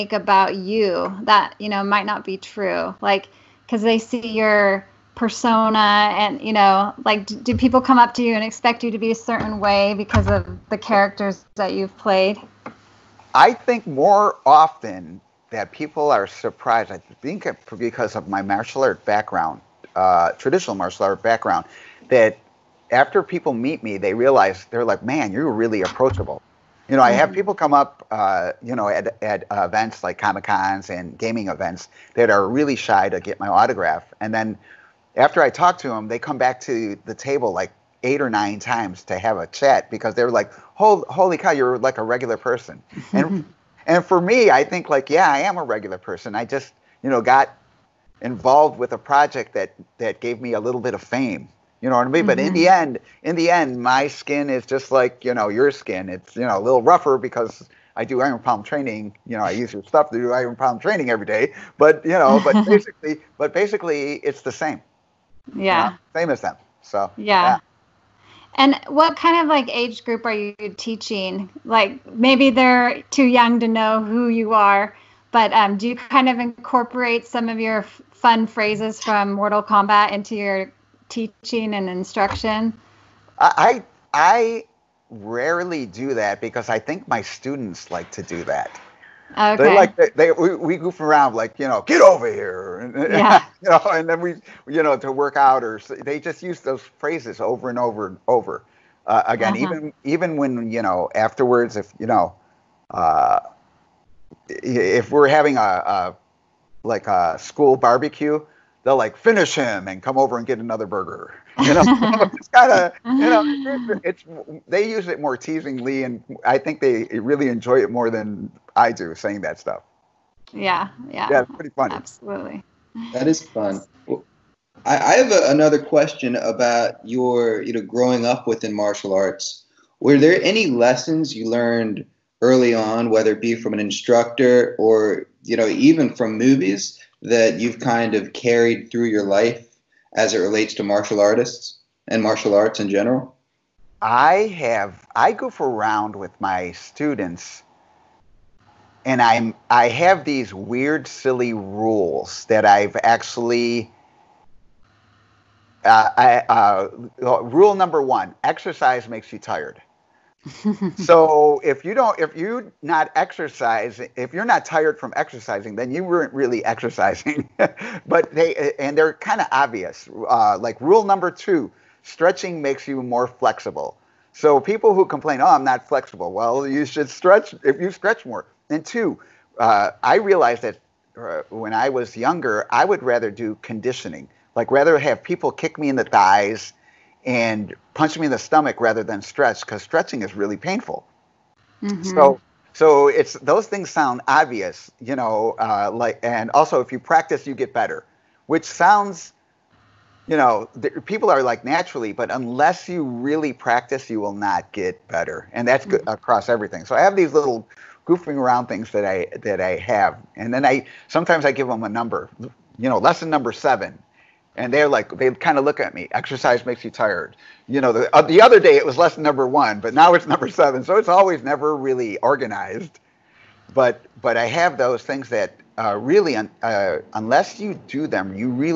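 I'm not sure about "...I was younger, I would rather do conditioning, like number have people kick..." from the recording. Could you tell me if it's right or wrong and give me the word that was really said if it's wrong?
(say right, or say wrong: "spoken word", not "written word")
wrong: "rather", not "number".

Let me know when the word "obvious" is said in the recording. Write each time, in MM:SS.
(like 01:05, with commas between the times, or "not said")
02:49, 03:14.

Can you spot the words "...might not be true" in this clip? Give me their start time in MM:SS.
00:01.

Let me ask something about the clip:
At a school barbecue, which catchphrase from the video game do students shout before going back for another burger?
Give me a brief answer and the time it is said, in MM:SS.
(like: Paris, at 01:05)
finish him, at 01:49.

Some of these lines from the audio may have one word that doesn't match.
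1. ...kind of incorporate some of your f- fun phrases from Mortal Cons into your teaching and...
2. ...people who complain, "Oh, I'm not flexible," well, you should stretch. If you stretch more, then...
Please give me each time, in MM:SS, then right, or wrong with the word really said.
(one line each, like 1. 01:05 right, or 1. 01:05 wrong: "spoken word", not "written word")
1. 01:15 wrong: "Kombat", not "Cons"
2. 02:54 right.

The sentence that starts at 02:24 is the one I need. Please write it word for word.
I have, I goof around with my students and I'm I have these weird, silly rules that I've actually.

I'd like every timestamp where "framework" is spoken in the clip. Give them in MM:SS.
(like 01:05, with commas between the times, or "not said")
not said.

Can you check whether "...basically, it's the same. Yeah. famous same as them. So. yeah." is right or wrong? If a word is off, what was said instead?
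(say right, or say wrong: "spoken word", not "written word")
right.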